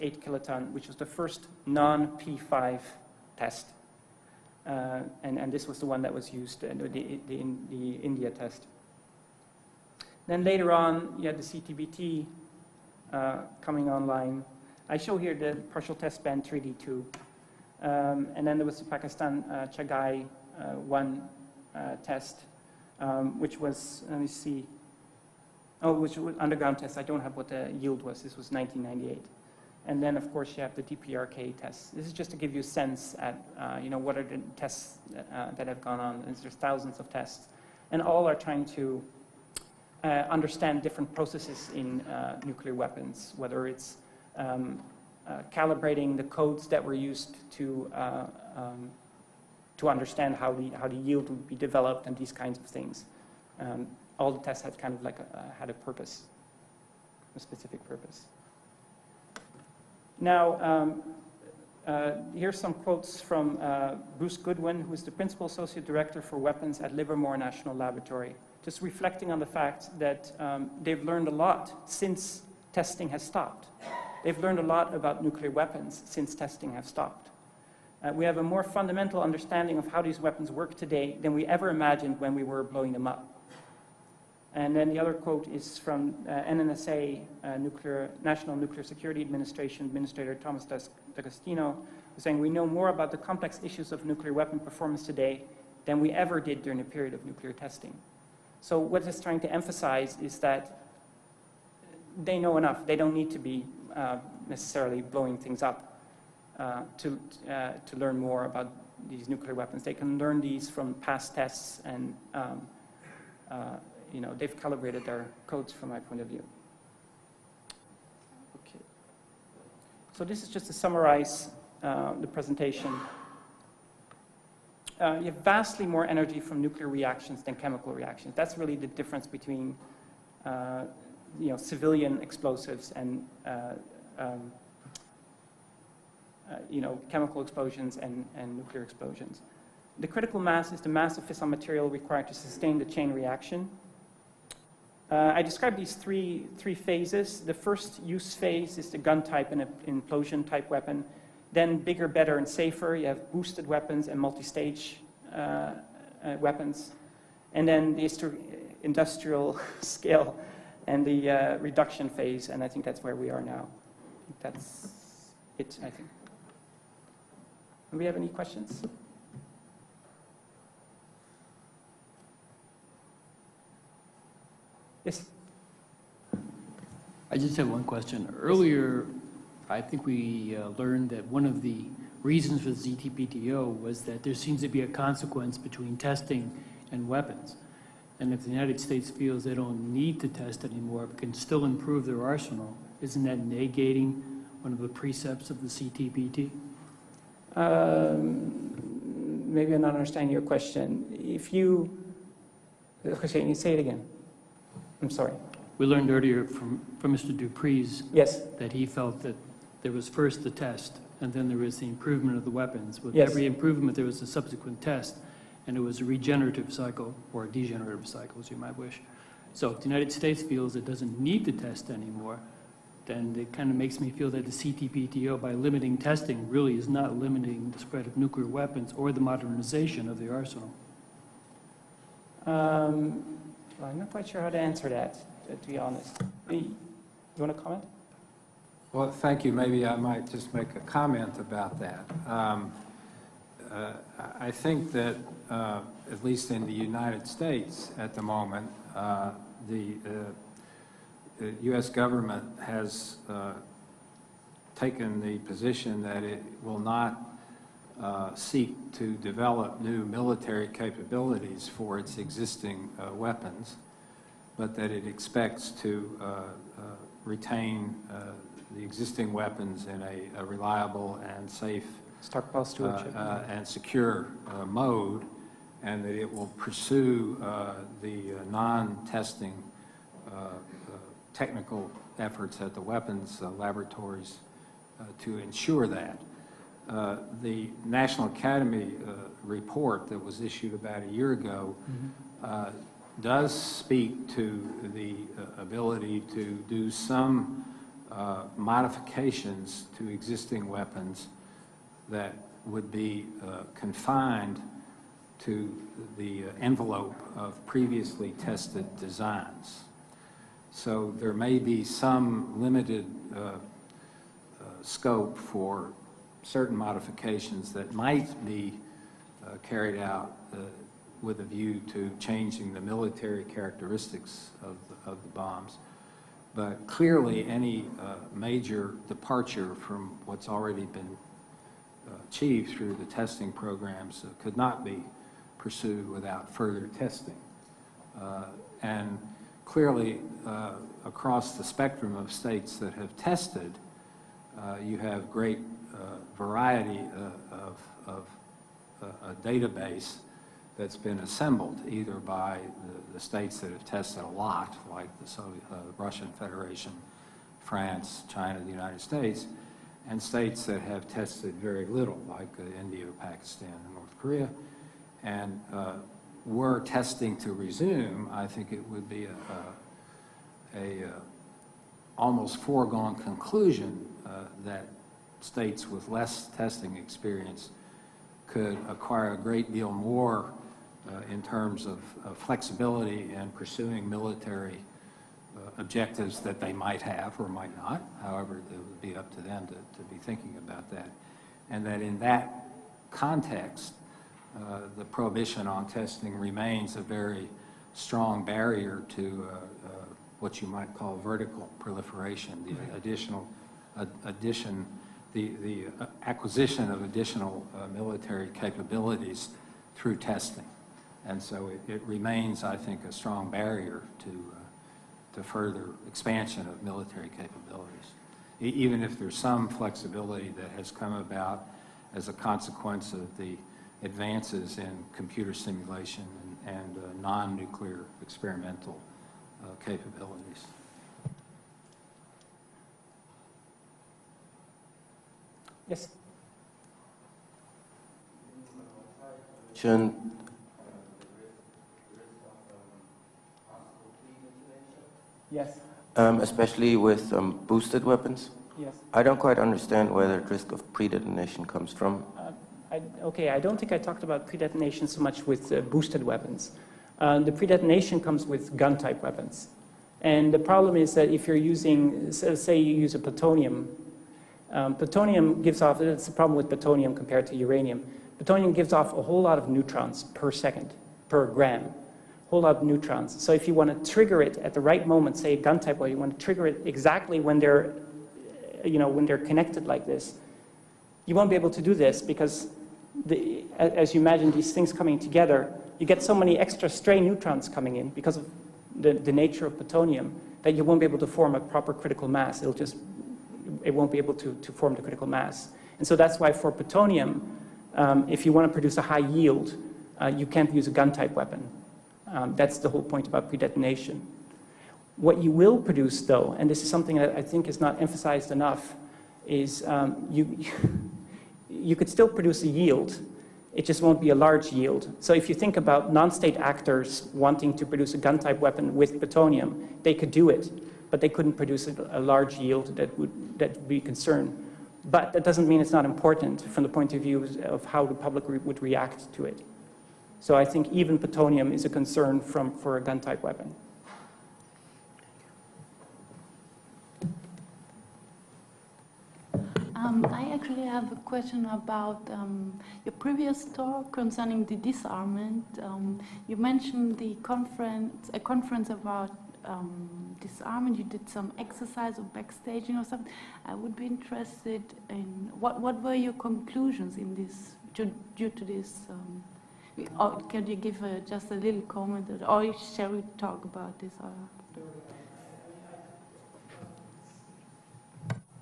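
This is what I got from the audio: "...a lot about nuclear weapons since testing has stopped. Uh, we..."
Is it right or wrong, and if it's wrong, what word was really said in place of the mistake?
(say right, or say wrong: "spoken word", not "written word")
right.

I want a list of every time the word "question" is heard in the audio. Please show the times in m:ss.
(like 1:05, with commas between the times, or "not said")
2:48, 2:57, 3:20, 9:01.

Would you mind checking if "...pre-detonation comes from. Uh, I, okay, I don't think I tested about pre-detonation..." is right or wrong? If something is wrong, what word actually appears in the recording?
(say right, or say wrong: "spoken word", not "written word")
wrong: "talked", not "tested".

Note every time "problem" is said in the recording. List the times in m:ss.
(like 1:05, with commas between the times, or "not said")
7:40, 7:46.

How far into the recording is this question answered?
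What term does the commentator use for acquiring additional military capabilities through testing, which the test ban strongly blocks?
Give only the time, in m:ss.
6:41.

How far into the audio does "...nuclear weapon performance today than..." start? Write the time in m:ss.
1:34.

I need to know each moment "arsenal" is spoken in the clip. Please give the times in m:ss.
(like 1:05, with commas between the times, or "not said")
3:12, 3:50.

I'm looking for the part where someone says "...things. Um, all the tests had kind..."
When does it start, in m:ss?
0:52.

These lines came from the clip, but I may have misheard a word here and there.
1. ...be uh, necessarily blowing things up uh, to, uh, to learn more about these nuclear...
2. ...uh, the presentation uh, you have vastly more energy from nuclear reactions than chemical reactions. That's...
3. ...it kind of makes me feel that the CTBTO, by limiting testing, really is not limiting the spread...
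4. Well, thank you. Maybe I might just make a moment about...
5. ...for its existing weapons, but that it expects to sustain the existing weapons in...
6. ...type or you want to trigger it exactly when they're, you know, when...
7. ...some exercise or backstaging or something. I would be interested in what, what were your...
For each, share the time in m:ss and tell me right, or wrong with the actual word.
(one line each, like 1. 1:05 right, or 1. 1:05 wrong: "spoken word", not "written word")
1. 1:43 right
2. 2:01 right
3. 3:43 right
4. 3:58 wrong: "comment", not "moment"
5. 4:21 wrong: "retain", not "sustain"
6. 7:55 right
7. 9:11 right.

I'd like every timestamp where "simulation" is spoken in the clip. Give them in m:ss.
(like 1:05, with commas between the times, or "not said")
7:05.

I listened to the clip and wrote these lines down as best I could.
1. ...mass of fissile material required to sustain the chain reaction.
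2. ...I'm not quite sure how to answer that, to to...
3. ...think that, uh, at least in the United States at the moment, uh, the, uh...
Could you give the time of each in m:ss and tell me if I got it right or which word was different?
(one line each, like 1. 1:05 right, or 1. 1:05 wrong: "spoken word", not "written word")
1. 2:20 right
2. 3:53 right
3. 4:04 right.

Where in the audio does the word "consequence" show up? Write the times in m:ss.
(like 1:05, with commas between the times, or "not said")
3:04, 7:02.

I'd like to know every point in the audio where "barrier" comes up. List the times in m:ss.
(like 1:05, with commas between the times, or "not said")
6:38, 6:53.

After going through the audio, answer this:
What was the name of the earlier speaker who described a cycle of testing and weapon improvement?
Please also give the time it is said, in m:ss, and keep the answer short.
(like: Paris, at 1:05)
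Dupree, at 3:27.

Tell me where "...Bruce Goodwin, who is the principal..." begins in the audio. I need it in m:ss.
1:04.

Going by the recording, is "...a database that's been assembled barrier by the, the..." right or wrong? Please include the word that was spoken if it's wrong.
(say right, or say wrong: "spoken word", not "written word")
wrong: "either", not "barrier".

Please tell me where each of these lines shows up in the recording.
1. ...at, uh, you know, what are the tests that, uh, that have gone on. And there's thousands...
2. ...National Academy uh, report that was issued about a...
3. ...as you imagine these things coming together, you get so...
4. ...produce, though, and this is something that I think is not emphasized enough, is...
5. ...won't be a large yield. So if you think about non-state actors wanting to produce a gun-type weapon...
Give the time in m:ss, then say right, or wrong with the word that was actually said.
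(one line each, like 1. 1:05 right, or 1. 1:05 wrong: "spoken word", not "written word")
1. 0:33 right
2. 4:47 right
3. 8:03 right
4. 8:25 right
5. 8:34 right.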